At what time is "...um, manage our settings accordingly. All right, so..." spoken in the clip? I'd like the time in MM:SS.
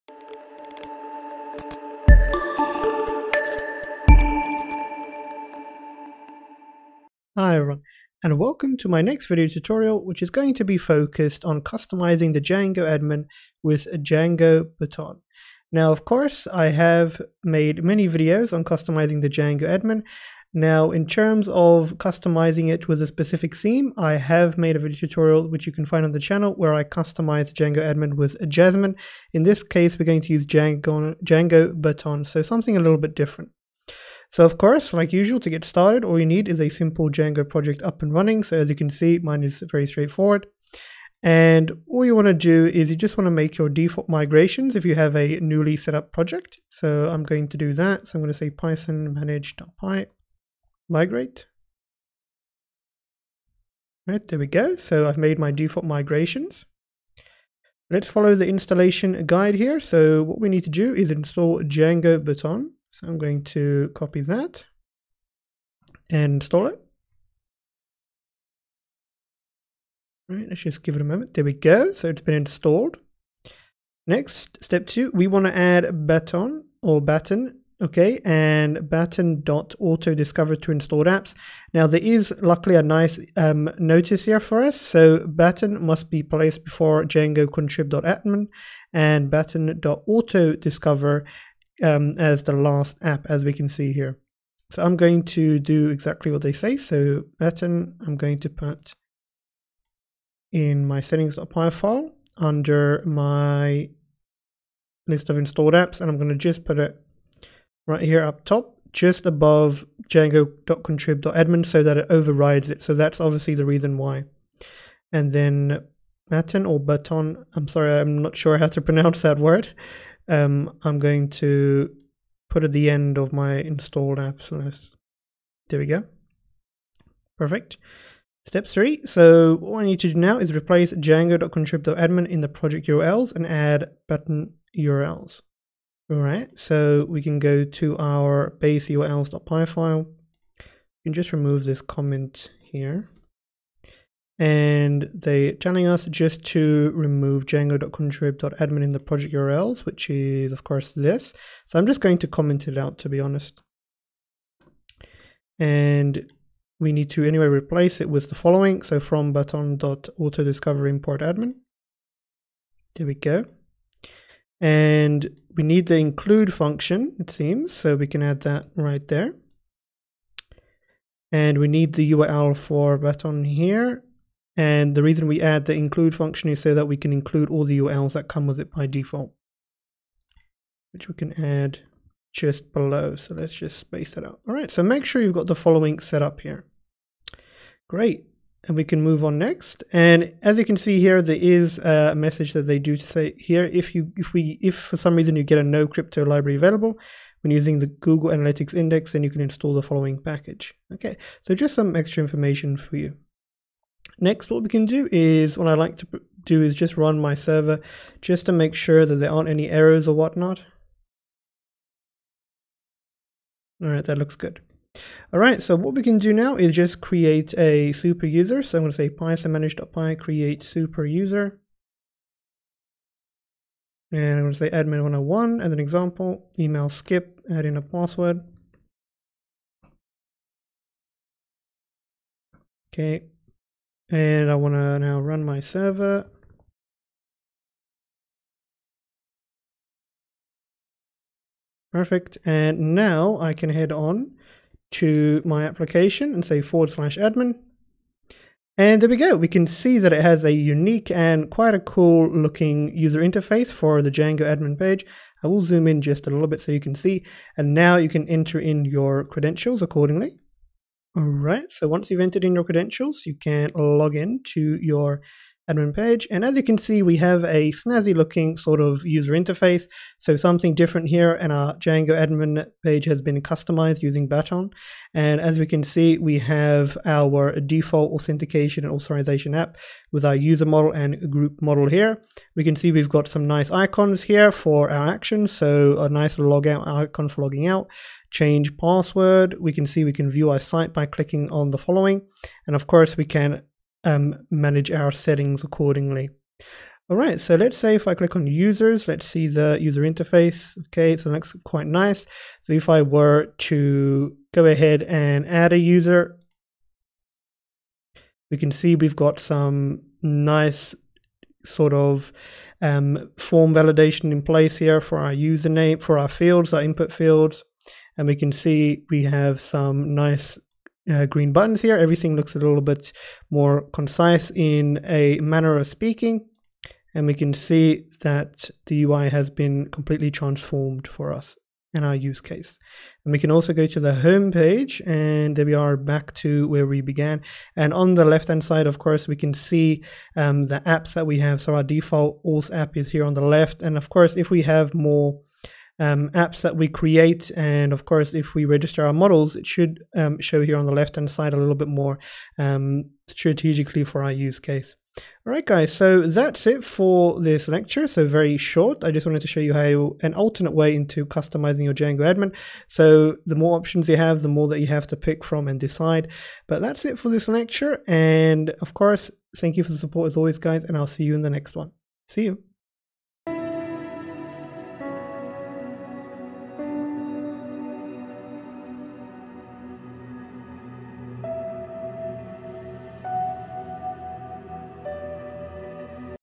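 04:54.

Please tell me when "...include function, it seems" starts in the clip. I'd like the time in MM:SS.
02:45.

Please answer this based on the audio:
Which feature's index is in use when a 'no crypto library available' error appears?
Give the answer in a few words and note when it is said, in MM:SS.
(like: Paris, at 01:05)
Google Analytics, at 03:17.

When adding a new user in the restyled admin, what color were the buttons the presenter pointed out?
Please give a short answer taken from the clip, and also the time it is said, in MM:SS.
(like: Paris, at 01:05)
green, at 05:21.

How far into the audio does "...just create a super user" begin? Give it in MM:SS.
03:36.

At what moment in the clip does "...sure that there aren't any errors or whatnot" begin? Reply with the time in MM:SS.
03:28.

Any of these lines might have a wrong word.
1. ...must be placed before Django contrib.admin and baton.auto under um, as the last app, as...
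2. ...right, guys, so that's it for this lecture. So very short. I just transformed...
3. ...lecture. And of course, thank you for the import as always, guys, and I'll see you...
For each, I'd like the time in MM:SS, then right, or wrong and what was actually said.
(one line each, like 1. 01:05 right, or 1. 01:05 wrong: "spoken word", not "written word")
1. 01:25 wrong: "discover", not "under"
2. 05:55 wrong: "wanted", not "transformed"
3. 06:07 wrong: "support", not "import".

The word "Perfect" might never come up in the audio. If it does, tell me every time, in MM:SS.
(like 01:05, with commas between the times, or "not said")
02:07, 04:01.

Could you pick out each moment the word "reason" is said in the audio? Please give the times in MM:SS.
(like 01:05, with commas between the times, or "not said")
01:53, 02:55, 03:15.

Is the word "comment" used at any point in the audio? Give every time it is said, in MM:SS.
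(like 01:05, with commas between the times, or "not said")
02:21, 02:32.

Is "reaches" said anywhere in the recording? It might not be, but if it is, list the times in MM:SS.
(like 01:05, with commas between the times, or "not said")
not said.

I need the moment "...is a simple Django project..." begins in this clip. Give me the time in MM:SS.
00:36.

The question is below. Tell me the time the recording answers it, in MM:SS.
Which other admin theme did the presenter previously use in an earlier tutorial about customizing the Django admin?
00:28.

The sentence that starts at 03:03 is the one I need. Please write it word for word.
So let's just space that out.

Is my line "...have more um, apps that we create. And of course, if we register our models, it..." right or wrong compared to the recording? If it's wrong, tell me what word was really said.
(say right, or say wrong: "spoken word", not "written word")
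right.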